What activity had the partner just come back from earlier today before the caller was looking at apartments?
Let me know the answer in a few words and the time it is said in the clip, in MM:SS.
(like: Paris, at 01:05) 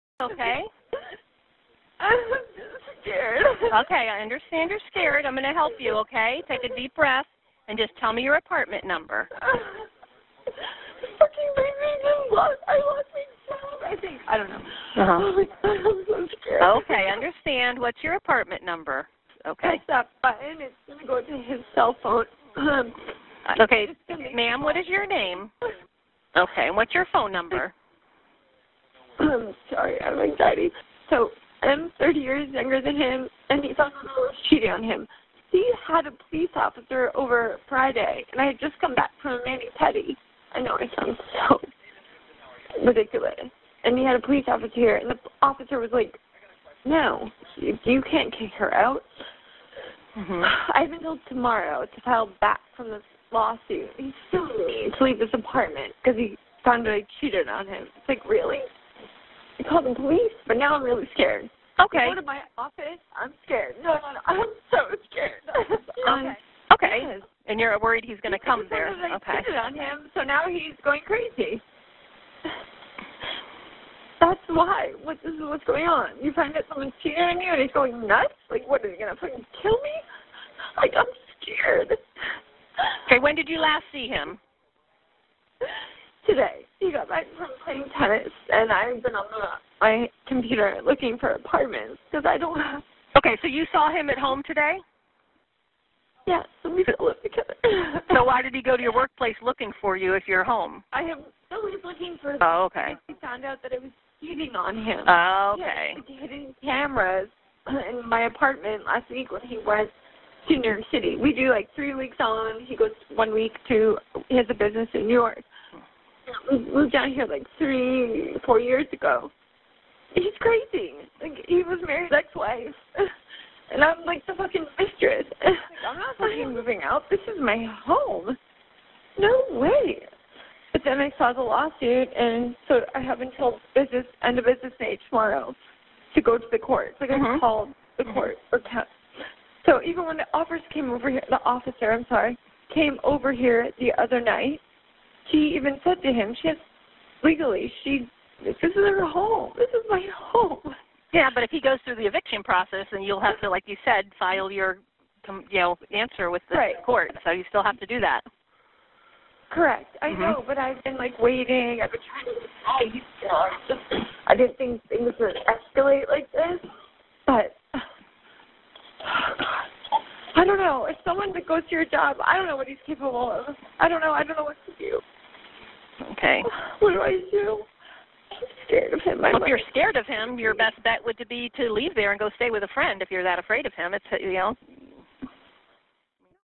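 playing tennis, at 01:27.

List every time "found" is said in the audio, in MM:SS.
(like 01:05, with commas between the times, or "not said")
00:56, 01:43.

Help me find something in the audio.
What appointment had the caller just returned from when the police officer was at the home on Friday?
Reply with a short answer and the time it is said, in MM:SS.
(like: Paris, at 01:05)
mani pedi, at 00:39.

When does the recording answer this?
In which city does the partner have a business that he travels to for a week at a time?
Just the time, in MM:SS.
01:50.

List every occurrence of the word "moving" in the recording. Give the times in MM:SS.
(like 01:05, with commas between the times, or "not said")
02:06.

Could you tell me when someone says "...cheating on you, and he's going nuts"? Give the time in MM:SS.
01:17.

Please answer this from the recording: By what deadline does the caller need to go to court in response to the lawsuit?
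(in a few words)
end of business day tomorrow.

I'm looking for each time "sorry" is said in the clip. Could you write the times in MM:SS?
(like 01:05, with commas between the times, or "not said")
00:29, 02:22.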